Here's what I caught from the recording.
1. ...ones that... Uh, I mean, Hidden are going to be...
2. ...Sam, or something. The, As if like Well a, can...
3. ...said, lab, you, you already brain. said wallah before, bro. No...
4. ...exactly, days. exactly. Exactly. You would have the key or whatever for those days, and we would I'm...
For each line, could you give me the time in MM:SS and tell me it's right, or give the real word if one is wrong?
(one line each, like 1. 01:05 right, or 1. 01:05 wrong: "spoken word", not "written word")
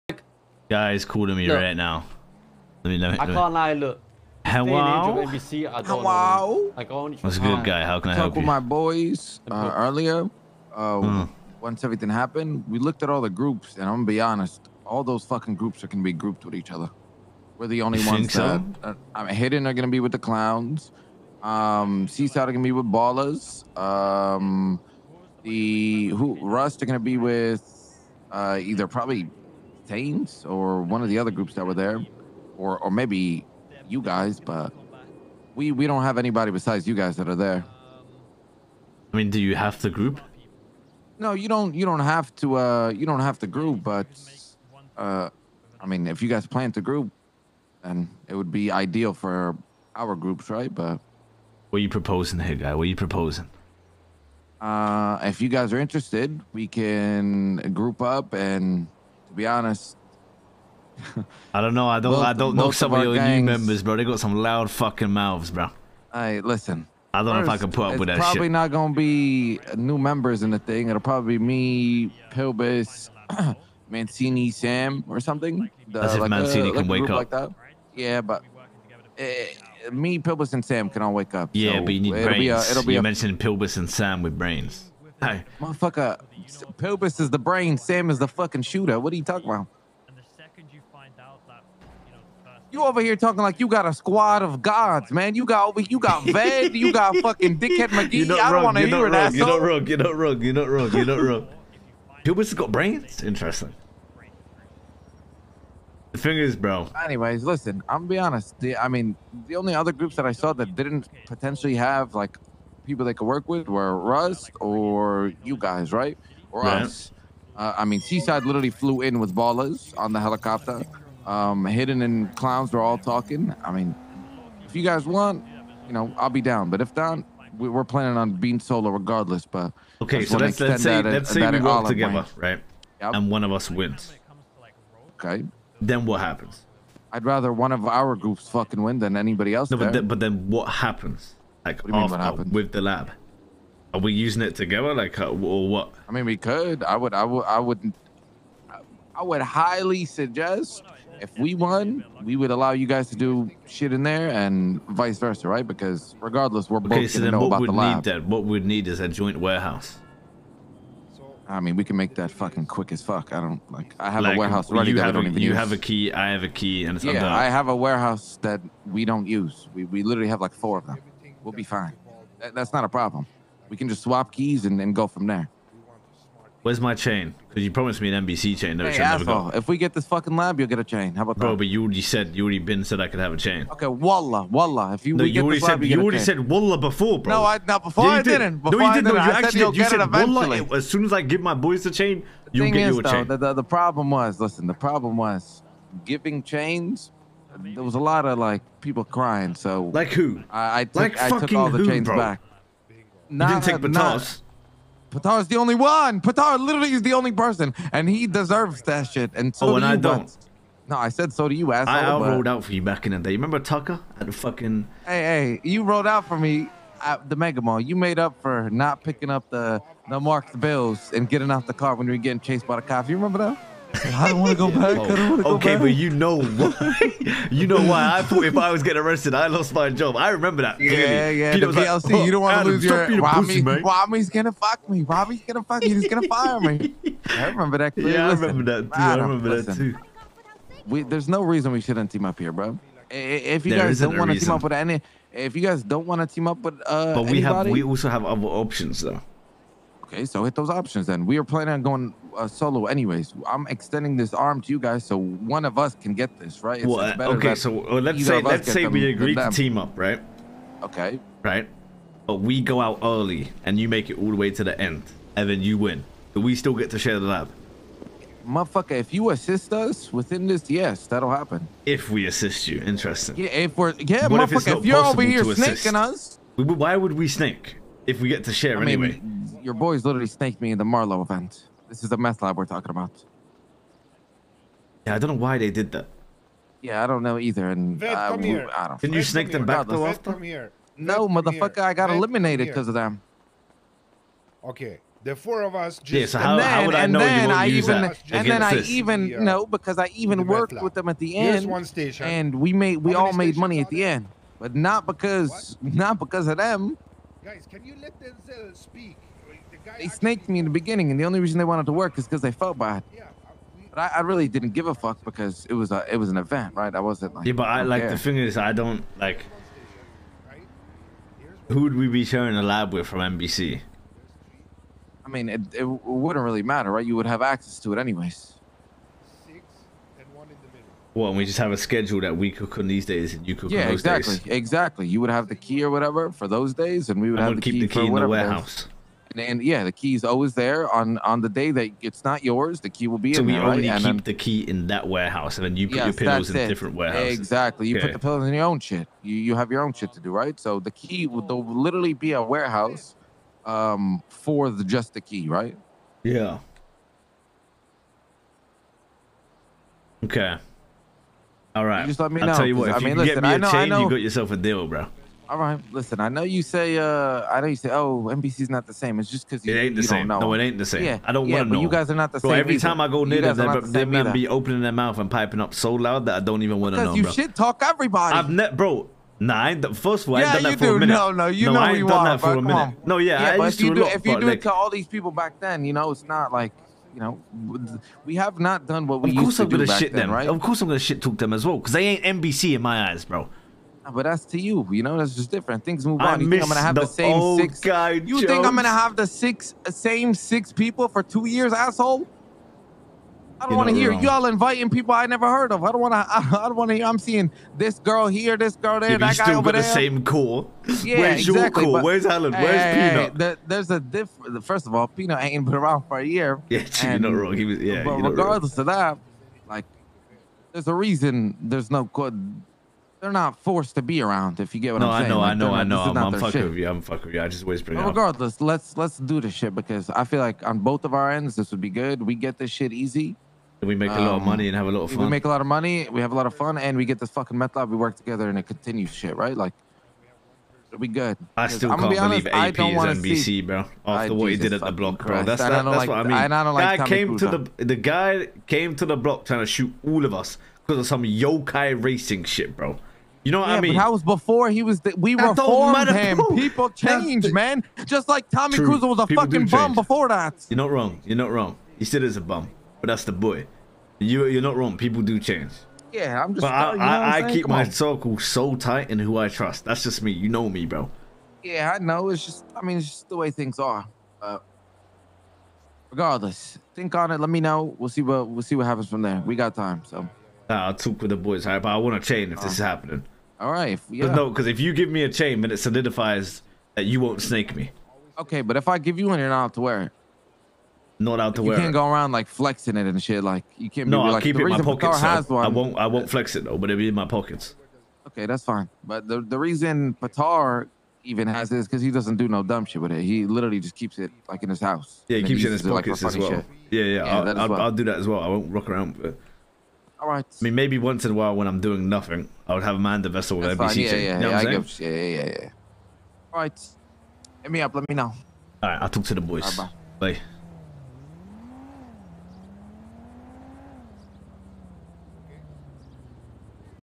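1. 00:18 right
2. 01:14 wrong: "Mancini", not "Well"
3. 03:05 wrong: "chain", not "brain"
4. 05:34 right.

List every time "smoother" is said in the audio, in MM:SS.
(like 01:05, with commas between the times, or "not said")
not said.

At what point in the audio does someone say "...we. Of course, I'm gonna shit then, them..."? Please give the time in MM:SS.
06:29.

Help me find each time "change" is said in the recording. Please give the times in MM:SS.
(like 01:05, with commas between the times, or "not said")
06:03, 07:36, 07:45.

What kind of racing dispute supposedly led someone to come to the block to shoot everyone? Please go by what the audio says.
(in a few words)
yokai racing.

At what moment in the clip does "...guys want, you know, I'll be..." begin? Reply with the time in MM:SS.
02:04.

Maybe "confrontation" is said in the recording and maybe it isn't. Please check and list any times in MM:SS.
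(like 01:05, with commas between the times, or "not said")
not said.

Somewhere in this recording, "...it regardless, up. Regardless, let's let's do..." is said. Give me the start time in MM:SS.
07:08.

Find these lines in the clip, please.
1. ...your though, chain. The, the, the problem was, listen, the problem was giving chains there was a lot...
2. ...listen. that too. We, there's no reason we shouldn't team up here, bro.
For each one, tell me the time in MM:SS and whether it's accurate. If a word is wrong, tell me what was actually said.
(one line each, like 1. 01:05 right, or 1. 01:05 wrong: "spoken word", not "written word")
1. 03:12 right
2. 03:59 right.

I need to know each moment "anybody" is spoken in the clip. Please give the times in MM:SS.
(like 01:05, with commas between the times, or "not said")
00:36, 02:19, 04:07.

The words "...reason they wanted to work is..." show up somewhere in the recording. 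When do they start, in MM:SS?
05:11.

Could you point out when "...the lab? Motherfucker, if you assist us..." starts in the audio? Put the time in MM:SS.
04:27.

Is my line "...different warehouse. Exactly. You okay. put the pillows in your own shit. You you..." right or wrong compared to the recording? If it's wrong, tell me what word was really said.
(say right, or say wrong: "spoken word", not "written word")
right.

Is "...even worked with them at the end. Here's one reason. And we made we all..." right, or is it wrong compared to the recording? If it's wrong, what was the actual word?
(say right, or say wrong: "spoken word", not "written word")
wrong: "station", not "reason".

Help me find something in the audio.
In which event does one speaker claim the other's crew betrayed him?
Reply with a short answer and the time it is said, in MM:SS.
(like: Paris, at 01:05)
Marlow event, at 04:40.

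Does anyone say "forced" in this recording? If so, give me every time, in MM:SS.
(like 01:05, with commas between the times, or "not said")
07:03.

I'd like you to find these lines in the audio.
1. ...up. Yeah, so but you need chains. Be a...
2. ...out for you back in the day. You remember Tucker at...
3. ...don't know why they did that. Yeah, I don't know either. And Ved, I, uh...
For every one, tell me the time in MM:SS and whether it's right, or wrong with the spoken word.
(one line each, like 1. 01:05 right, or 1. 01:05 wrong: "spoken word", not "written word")
1. 01:21 wrong: "brains", not "chains"
2. 03:32 right
3. 04:45 wrong: "Vet", not "Ved".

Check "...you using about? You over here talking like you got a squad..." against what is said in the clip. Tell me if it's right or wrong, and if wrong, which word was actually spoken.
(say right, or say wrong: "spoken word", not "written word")
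wrong: "talking", not "using".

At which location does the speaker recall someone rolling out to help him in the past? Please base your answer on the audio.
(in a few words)
Mega Mall.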